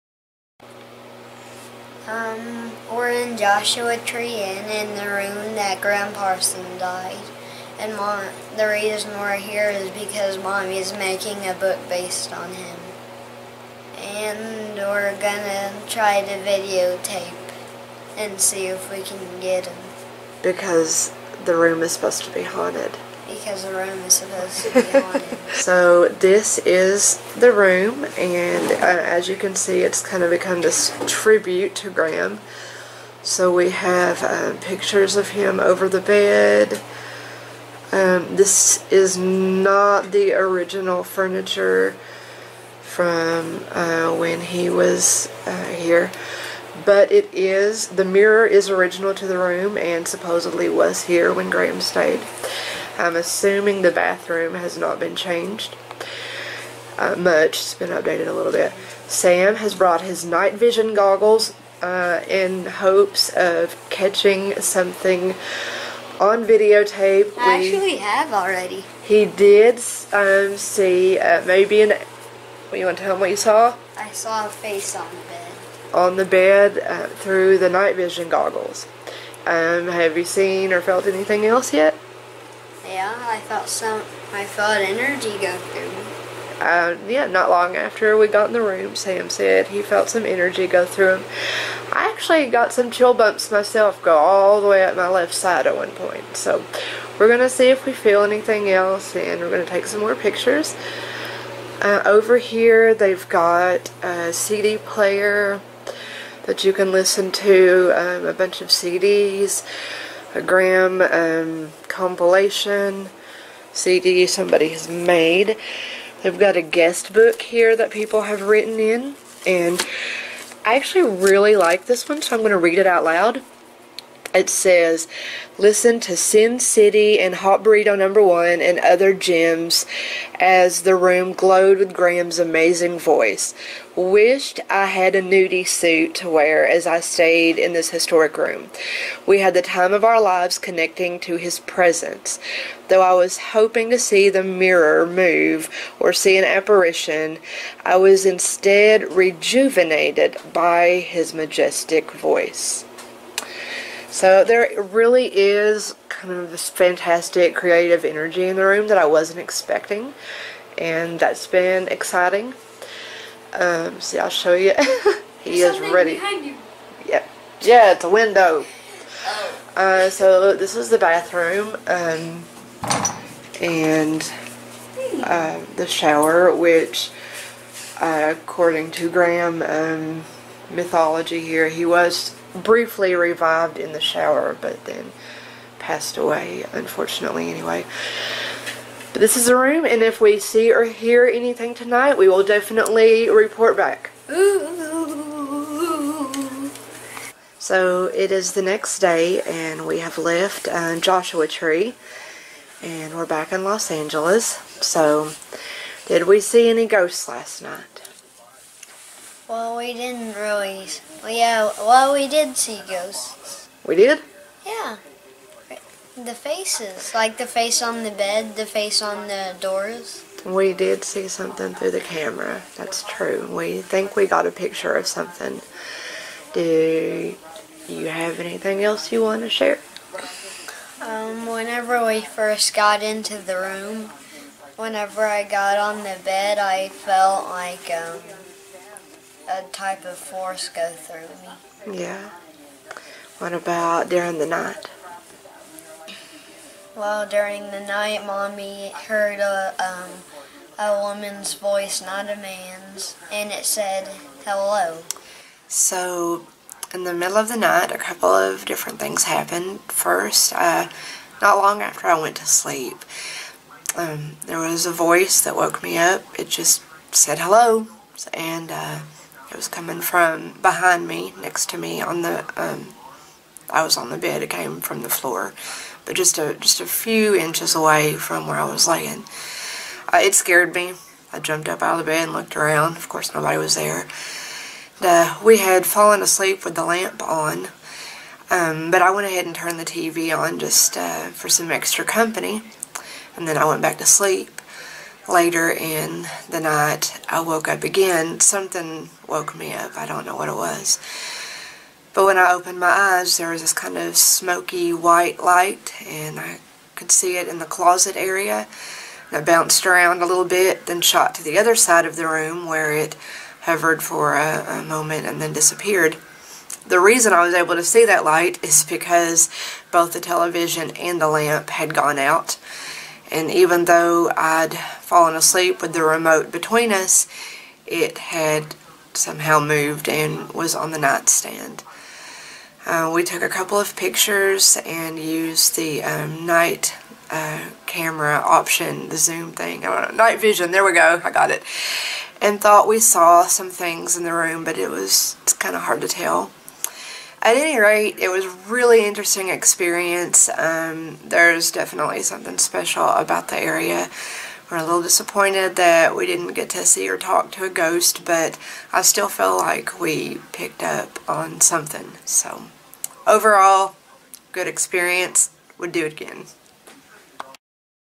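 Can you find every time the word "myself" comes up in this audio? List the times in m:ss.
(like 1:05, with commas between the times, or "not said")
1:33.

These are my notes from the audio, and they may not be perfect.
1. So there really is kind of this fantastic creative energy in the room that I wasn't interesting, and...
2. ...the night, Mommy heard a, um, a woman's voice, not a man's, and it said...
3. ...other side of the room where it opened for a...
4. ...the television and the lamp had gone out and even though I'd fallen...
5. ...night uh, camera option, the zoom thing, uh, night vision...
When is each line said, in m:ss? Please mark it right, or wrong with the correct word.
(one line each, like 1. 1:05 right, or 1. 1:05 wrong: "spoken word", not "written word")
1. 2:34 wrong: "expecting", not "interesting"
2. 4:07 right
3. 5:11 wrong: "hovered", not "opened"
4. 5:20 right
5. 5:36 right.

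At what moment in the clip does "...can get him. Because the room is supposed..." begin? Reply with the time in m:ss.
0:19.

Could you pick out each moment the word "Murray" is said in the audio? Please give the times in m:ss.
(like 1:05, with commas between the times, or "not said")
not said.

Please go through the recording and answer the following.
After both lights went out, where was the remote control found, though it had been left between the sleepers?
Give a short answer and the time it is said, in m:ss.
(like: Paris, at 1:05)
On the nightstand, at 5:30.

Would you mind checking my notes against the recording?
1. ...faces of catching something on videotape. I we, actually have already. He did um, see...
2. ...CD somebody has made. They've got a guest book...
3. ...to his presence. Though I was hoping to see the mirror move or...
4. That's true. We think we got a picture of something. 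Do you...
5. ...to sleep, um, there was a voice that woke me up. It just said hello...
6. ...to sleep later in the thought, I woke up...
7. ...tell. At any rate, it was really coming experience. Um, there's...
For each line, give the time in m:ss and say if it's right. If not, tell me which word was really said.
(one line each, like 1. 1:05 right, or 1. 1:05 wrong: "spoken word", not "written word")
1. 1:02 wrong: "hopes", not "faces"
2. 1:53 right
3. 2:21 right
4. 3:42 right
5. 4:22 right
6. 4:53 wrong: "night", not "thought"
7. 5:46 wrong: "interesting", not "coming".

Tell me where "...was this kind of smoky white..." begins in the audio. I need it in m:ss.
5:03.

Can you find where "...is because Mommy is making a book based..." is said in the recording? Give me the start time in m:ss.
0:09.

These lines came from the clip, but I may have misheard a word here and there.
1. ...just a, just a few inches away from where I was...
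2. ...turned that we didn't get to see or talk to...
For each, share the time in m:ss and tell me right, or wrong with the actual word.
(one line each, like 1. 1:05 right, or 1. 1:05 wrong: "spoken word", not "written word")
1. 4:36 right
2. 5:55 wrong: "disappointed", not "turned".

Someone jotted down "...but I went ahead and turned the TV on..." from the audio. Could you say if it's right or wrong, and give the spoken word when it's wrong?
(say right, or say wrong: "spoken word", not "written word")
right.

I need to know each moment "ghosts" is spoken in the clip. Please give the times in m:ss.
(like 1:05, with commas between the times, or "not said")
3:26, 3:32, 5:57.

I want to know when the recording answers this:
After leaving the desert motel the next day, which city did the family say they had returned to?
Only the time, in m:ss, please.
3:23.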